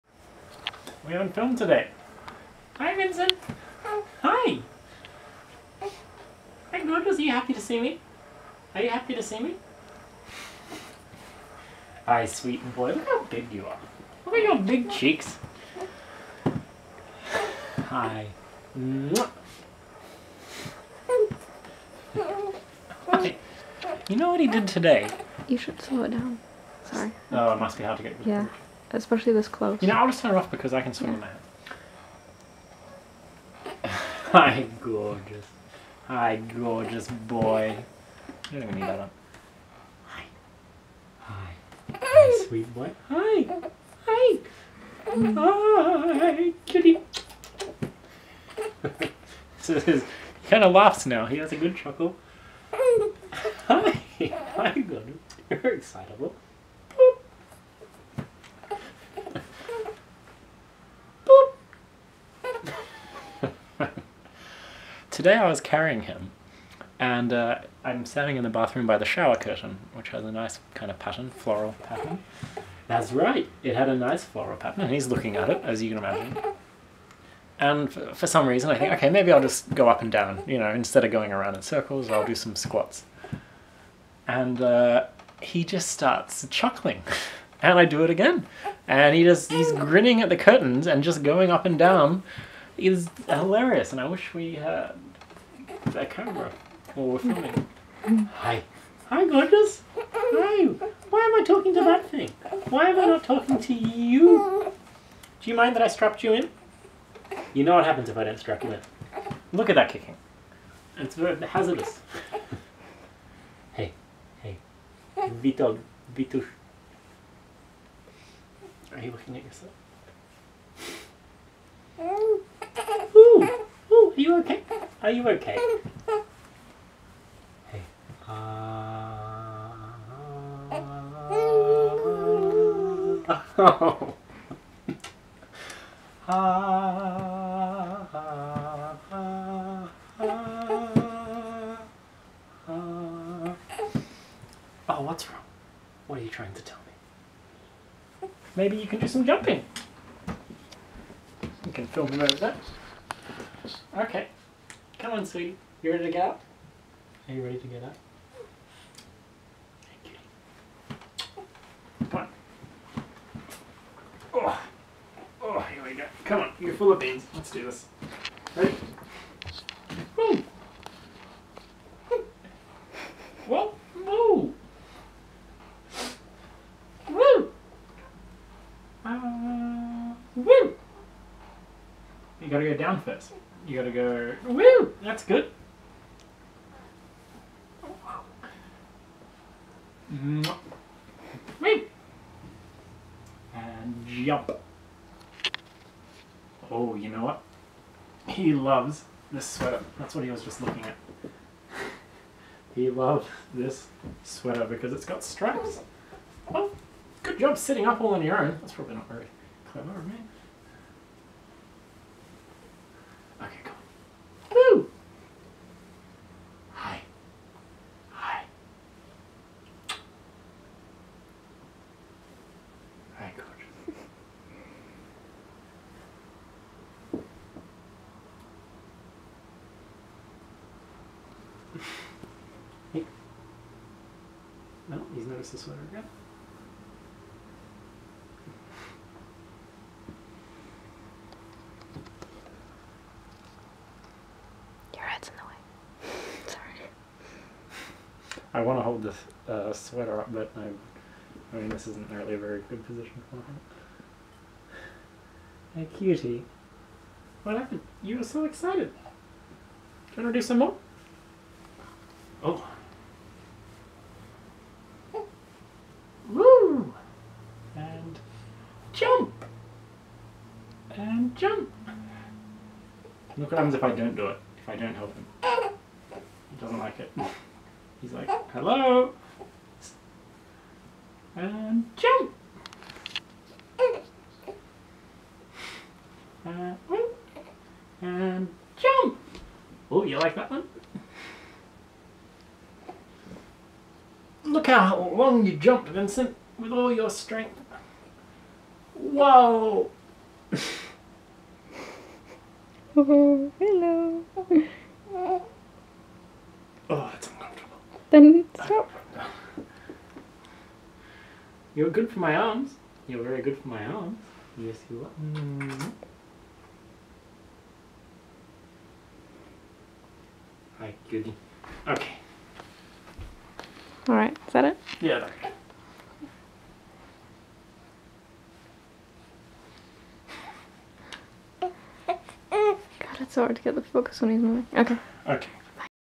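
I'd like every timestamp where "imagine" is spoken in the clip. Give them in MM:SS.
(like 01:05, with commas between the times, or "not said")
01:15.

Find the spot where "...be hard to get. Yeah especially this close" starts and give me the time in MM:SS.
00:27.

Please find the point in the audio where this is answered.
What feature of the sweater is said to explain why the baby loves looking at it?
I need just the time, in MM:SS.
03:25.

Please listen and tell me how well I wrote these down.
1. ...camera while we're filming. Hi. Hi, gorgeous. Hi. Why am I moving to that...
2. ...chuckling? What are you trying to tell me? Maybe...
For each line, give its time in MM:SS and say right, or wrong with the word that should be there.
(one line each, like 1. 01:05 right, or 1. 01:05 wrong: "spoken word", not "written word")
1. 01:36 wrong: "talking", not "moving"
2. 02:25 wrong: "wrong", not "chuckling".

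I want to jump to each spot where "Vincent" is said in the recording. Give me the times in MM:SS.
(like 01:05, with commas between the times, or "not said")
00:02, 04:55.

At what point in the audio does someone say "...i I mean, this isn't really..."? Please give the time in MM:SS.
04:10.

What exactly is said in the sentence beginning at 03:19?
That's what he was just looking at.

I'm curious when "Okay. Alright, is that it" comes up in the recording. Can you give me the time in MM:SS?
05:21.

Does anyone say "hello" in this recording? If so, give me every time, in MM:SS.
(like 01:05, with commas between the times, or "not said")
04:38, 05:03.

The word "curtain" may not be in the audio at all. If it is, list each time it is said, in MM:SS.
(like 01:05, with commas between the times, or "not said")
01:09, 01:30.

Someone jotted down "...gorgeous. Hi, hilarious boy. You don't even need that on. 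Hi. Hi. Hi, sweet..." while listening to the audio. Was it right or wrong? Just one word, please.
wrong.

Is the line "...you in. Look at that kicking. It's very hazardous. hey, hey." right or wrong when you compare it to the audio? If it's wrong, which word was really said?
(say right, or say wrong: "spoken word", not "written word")
right.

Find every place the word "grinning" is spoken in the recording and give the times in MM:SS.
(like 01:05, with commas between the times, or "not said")
01:29.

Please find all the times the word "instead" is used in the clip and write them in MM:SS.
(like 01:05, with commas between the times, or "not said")
01:20.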